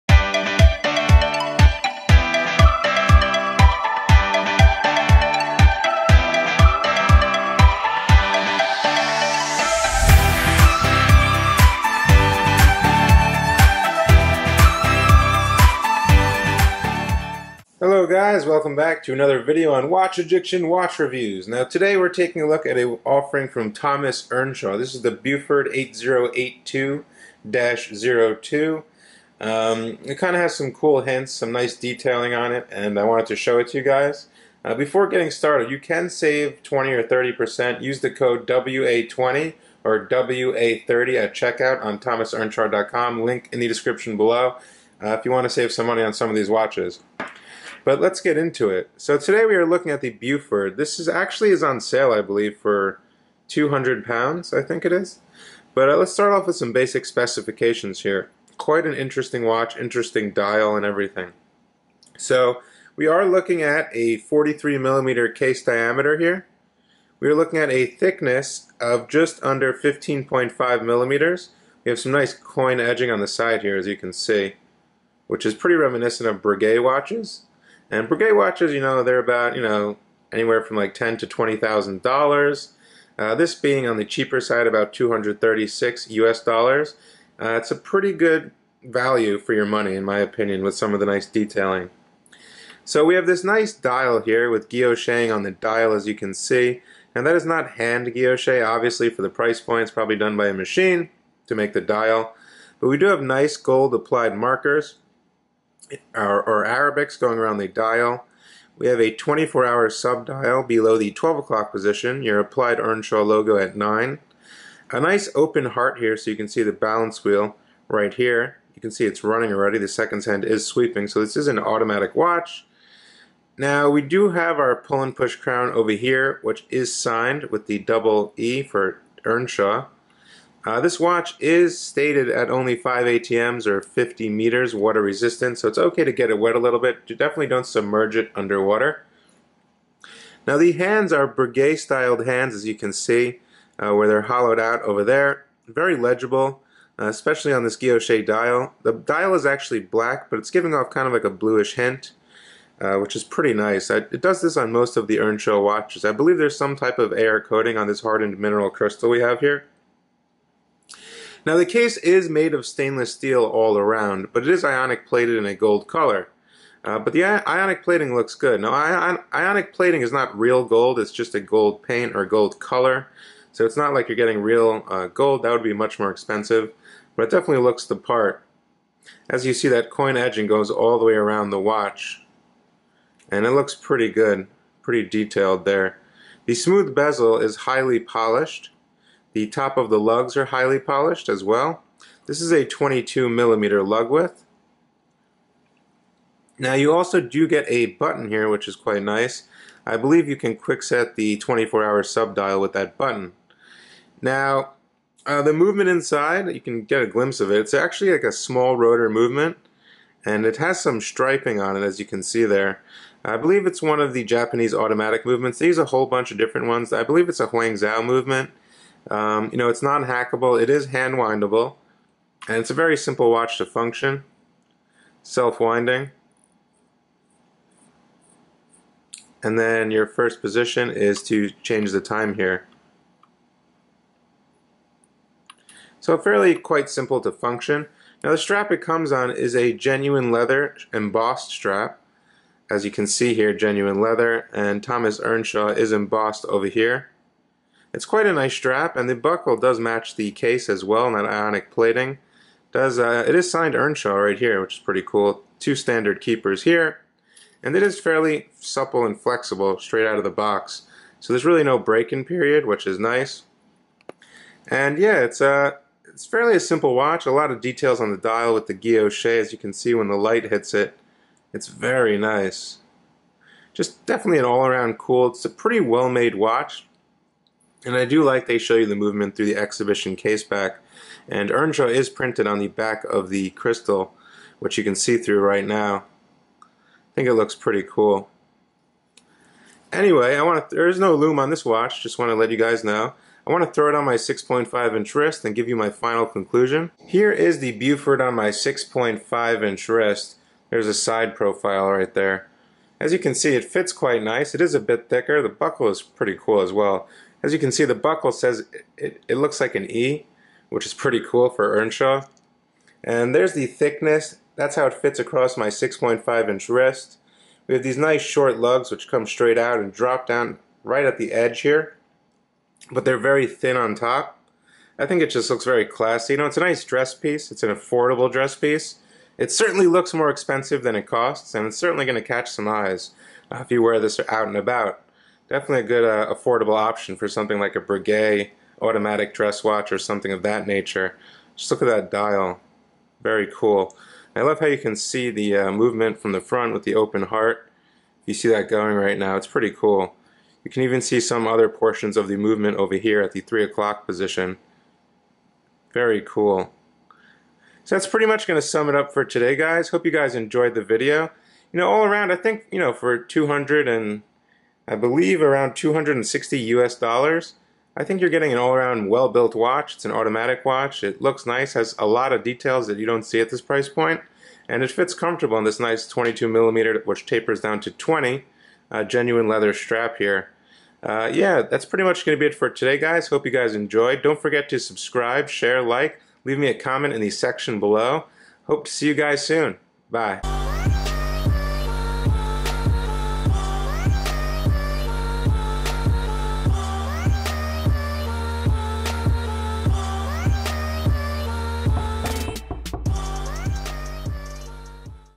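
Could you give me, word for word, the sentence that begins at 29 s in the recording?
Um, it kind of has some cool hints, some nice detailing on it, and I wanted to show it to you guys.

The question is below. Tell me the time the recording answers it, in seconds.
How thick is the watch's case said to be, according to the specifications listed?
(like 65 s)
69 s.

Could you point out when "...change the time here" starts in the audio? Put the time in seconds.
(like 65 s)
231 s.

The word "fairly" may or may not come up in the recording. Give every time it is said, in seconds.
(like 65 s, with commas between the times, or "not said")
236 s, 257 s, 266 s.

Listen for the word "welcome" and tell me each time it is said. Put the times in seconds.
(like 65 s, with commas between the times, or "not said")
18 s.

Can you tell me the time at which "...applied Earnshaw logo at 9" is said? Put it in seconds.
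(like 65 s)
112 s.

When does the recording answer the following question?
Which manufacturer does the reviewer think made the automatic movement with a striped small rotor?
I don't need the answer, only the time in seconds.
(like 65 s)
217 s.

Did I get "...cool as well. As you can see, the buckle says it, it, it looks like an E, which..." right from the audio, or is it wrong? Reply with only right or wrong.
right.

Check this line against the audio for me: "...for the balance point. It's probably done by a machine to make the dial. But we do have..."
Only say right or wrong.
wrong.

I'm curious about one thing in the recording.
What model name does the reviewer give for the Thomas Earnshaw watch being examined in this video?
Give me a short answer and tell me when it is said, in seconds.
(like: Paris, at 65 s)
Beaufort 8082-02, at 25 s.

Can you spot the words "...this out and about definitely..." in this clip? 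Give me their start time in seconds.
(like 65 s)
333 s.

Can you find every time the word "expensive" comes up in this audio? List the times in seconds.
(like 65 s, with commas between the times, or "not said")
176 s, 330 s.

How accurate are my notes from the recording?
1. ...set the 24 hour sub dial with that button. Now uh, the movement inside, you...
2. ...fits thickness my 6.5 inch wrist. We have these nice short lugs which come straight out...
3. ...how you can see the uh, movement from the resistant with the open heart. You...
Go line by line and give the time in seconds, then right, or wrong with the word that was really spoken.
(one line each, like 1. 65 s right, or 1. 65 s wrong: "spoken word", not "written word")
1. 200 s right
2. 314 s wrong: "across", not "thickness"
3. 344 s wrong: "front", not "resistant".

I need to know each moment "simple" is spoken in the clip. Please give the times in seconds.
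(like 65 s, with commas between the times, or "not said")
222 s, 236 s, 266 s.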